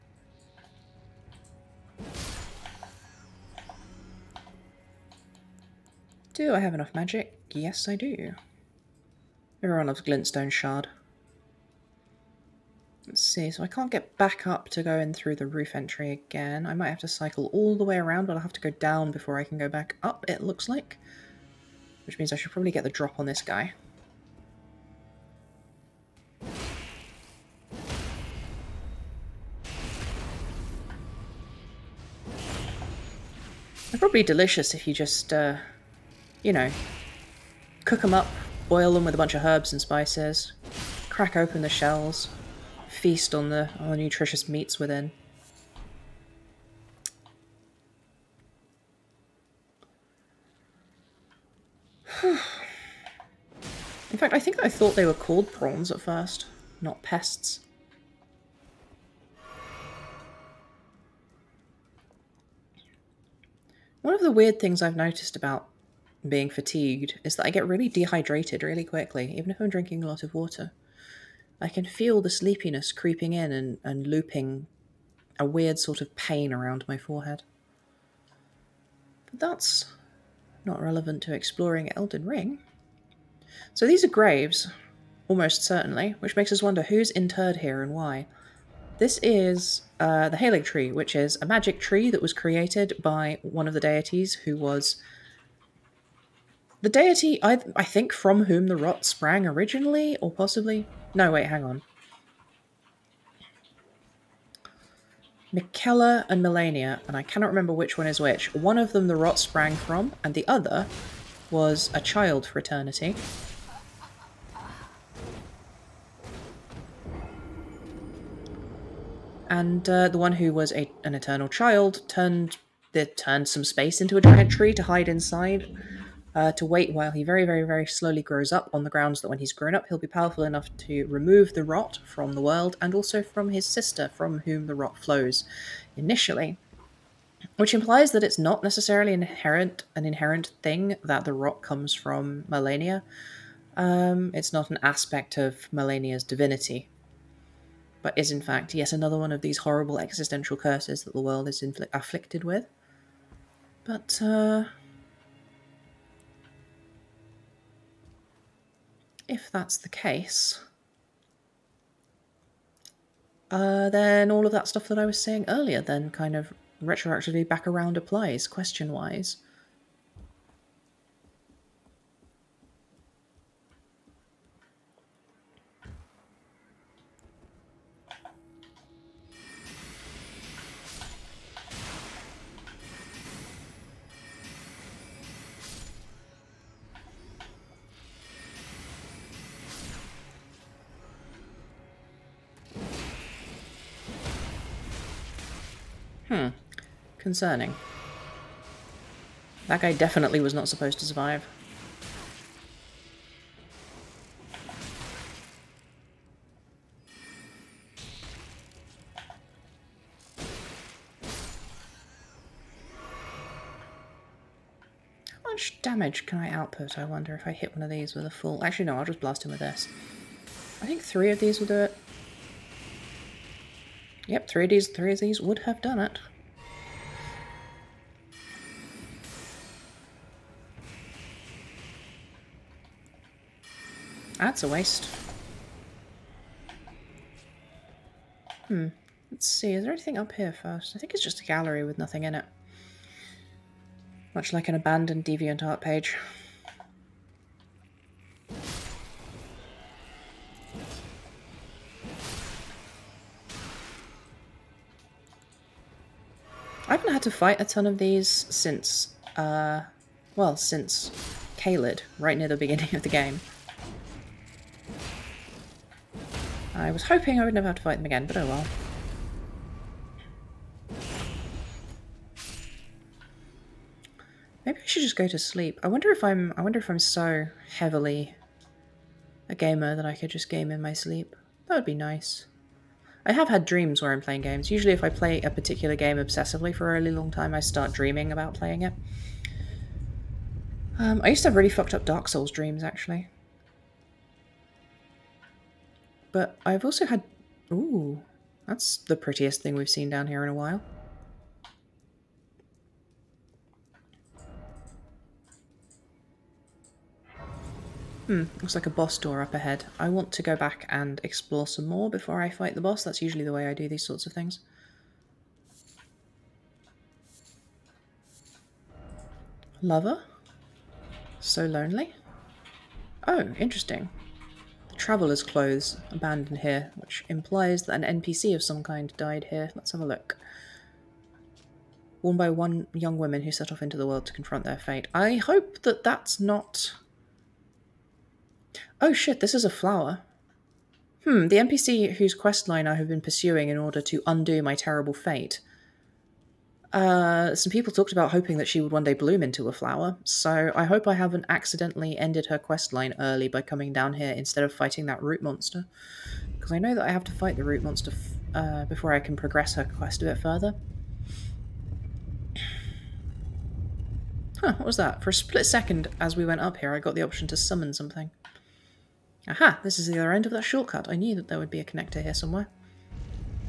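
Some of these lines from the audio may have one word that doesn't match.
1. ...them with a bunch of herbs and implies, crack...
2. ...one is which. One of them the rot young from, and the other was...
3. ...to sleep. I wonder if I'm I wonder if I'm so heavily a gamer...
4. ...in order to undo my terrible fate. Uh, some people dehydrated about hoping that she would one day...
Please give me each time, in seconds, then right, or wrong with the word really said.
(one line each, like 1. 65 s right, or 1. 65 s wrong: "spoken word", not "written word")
1. 38 s wrong: "spices", not "implies"
2. 107 s wrong: "sprang", not "young"
3. 275 s right
4. 343 s wrong: "talked", not "dehydrated".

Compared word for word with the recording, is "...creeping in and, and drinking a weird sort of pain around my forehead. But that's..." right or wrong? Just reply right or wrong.
wrong.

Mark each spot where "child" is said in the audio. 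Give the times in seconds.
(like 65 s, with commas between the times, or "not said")
112 s, 121 s.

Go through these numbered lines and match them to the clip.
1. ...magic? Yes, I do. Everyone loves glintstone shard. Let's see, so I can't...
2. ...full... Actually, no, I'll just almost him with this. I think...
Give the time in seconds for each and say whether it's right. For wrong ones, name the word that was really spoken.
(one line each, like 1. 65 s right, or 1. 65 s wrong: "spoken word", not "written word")
1. 6 s right
2. 218 s wrong: "blast", not "almost".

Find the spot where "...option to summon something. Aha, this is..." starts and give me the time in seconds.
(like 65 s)
367 s.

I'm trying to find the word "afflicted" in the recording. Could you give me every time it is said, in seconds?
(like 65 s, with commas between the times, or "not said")
151 s.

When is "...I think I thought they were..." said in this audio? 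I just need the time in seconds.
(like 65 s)
54 s.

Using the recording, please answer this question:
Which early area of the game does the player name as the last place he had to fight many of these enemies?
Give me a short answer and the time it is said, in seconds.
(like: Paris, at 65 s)
Caelid, at 261 s.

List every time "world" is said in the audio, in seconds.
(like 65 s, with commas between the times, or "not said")
132 s, 151 s, 334 s.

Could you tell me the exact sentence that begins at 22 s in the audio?
Which means I should probably get the drop on this guy.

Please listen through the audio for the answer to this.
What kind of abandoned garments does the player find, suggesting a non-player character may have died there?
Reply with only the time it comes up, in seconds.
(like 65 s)
324 s.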